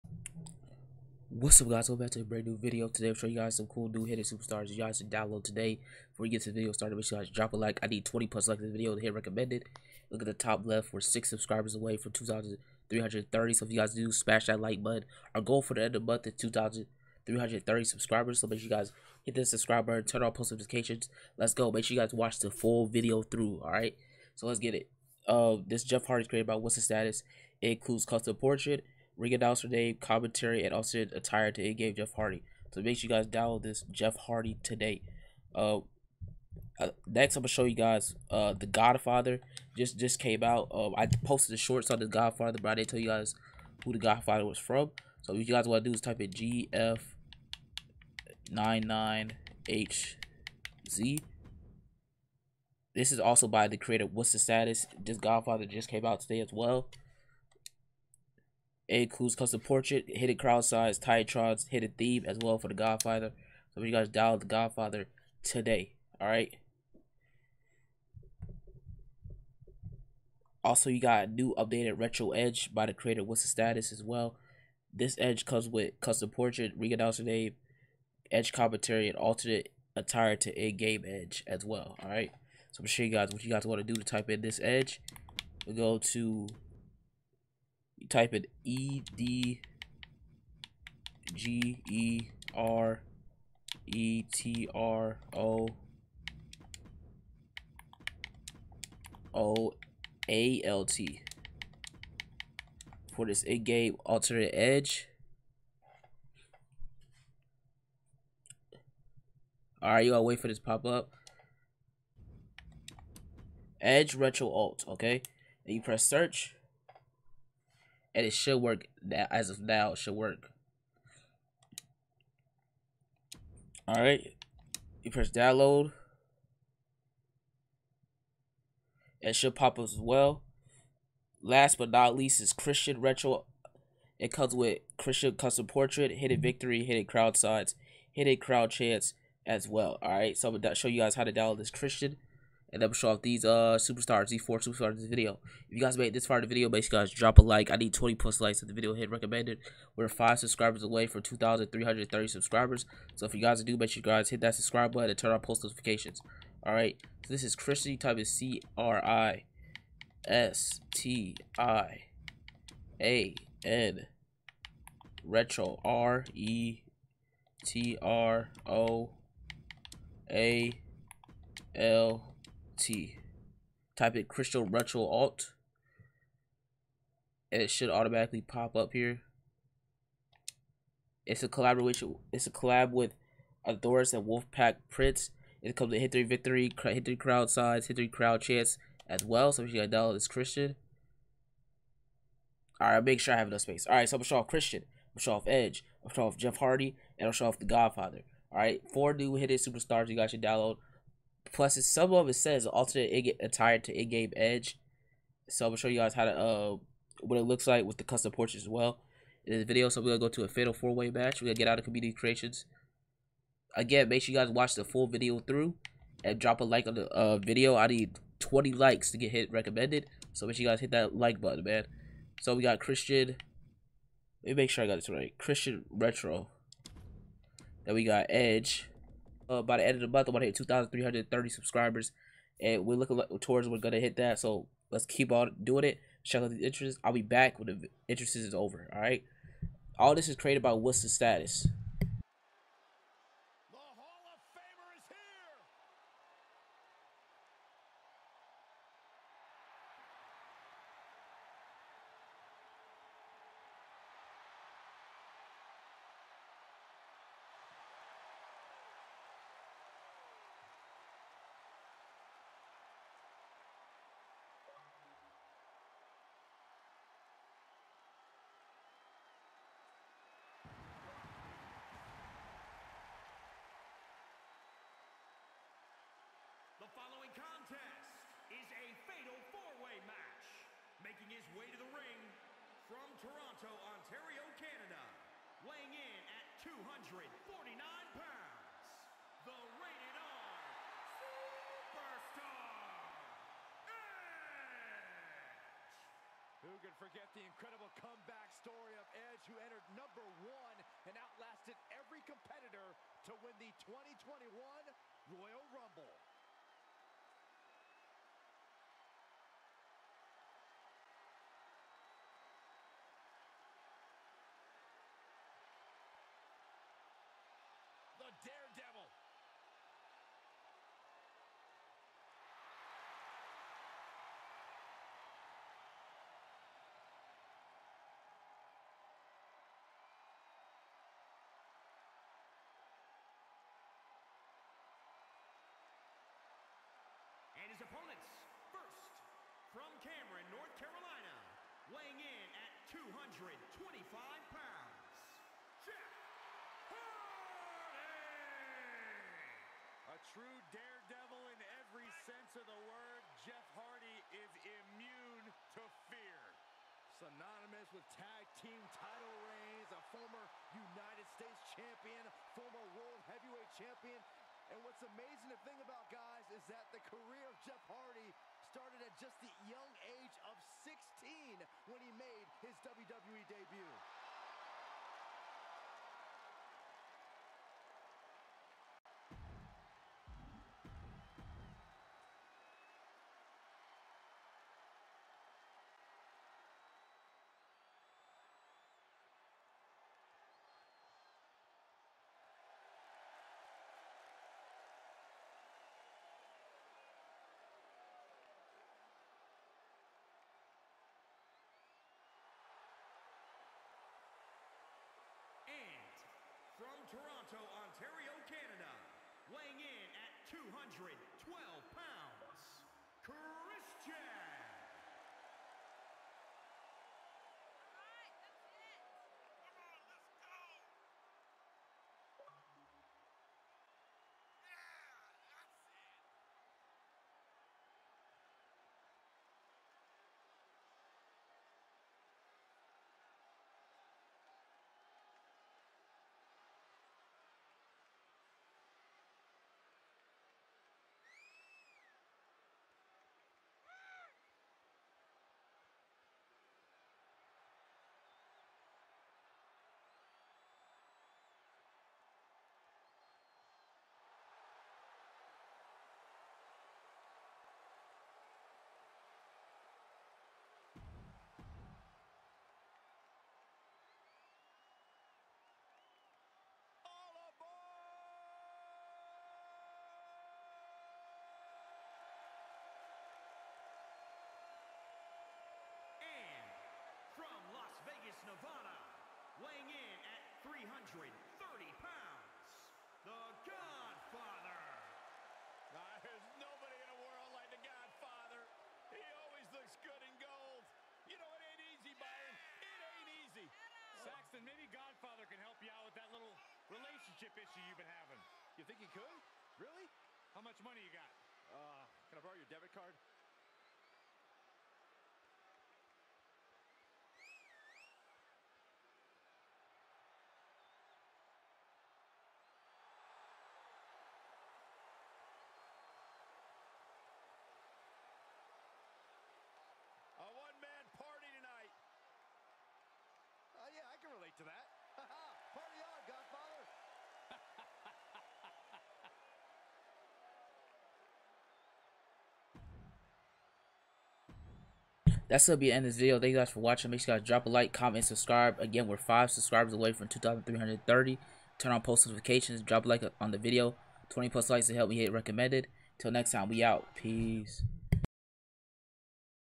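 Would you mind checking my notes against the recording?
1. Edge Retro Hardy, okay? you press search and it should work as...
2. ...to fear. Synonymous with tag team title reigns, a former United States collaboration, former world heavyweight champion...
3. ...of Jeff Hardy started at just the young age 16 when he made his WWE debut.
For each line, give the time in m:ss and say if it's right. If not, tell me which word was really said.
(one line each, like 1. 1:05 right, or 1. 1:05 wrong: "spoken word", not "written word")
1. 1:53 wrong: "Alt", not "Hardy"
2. 5:55 wrong: "champion", not "collaboration"
3. 6:07 right.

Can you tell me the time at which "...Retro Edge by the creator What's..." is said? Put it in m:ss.
1:11.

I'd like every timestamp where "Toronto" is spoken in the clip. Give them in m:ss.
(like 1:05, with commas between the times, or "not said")
4:43, 6:47.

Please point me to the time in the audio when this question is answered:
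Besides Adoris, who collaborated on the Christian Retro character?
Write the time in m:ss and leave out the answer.
3:04.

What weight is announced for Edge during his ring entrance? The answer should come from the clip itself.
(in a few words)
249 pounds.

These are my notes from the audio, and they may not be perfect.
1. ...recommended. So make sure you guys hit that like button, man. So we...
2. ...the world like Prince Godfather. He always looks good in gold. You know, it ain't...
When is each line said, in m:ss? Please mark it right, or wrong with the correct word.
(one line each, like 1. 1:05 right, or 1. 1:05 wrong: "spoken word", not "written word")
1. 3:39 right
2. 8:07 wrong: "The", not "Prince".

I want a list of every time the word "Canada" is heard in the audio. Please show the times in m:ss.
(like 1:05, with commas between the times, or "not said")
4:44, 6:48.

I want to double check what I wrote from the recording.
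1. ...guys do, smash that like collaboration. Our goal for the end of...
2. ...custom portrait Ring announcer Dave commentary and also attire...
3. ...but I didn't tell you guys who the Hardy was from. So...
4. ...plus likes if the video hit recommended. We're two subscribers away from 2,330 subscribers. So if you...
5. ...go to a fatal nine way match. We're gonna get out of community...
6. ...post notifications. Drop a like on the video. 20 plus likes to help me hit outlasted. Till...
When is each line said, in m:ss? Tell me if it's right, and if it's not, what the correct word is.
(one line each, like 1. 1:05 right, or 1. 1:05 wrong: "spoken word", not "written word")
1. 0:13 wrong: "button", not "collaboration"
2. 0:28 right
3. 0:42 wrong: "Godfather", not "Hardy"
4. 2:28 wrong: "five", not "two"
5. 3:30 wrong: "four", not "nine"
6. 9:02 wrong: "recommended", not "outlasted".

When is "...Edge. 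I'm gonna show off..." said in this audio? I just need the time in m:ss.
3:15.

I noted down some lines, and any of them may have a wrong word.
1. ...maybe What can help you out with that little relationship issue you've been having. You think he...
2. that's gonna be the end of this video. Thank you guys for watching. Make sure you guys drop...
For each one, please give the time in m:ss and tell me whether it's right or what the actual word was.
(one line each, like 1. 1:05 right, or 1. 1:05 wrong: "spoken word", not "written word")
1. 8:14 wrong: "Godfather", not "What"
2. 8:55 right.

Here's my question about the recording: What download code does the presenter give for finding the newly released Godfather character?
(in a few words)
GF99HZ.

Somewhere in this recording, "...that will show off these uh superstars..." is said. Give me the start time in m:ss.
2:22.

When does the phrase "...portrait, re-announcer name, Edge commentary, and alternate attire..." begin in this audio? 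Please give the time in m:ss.
1:16.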